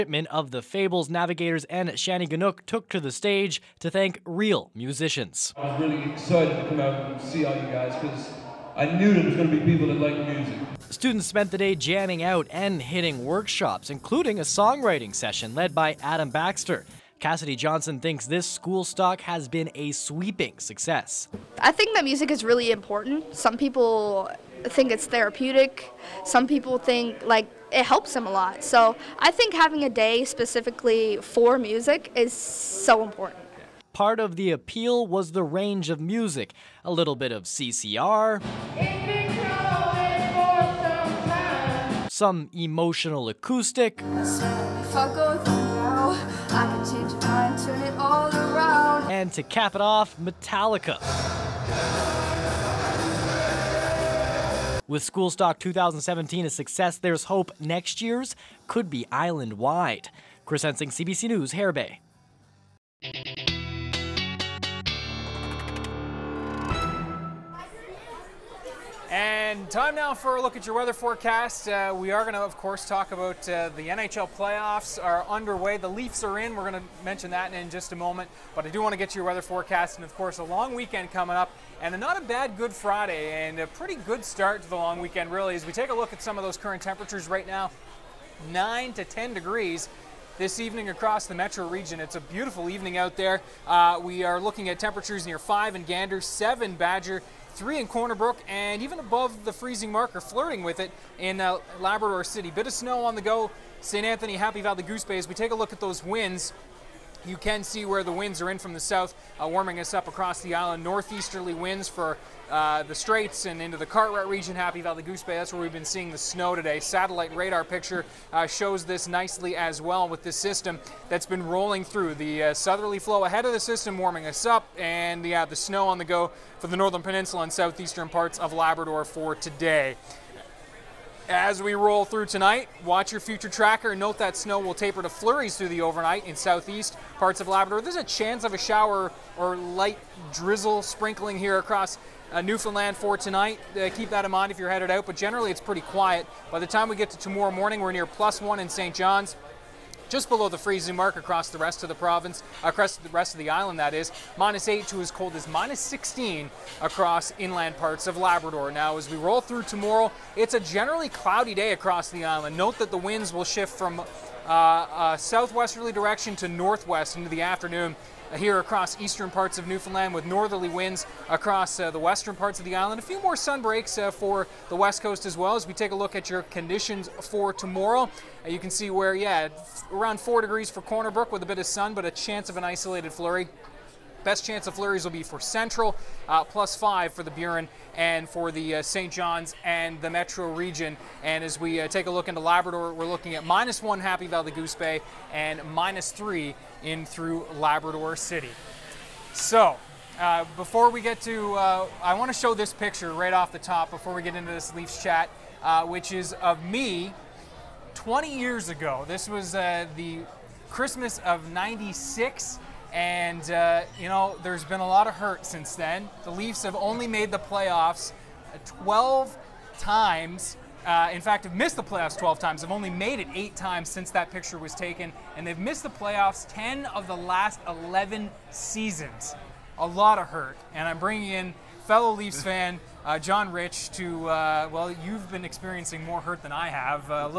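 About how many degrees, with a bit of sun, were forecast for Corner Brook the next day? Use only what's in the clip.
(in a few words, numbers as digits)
4 degrees.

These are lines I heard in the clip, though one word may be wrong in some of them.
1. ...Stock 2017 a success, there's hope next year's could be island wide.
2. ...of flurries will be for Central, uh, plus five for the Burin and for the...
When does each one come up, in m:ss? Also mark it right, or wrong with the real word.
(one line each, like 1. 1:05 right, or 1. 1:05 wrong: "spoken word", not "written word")
1. 0:55 right
2. 3:04 right.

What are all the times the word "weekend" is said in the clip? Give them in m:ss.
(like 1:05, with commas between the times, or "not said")
1:20, 1:25.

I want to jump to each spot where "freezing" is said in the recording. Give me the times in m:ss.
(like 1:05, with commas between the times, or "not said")
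1:39, 2:30.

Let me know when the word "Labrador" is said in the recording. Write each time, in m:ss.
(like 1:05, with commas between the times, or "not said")
1:41, 2:08, 2:17, 2:38, 3:12, 3:17.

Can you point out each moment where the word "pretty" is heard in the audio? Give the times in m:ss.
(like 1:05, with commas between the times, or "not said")
1:23, 2:25.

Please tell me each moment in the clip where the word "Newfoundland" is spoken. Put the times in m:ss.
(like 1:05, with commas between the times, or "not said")
2:22, 2:49.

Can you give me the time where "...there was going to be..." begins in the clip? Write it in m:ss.
0:09.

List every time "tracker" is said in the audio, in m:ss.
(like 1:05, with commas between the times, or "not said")
2:13.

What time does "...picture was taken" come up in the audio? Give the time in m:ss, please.
3:44.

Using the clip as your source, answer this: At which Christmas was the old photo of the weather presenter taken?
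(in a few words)
Christmas of 1996.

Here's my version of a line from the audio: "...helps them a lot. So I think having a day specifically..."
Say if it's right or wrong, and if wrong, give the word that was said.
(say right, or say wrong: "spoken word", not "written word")
right.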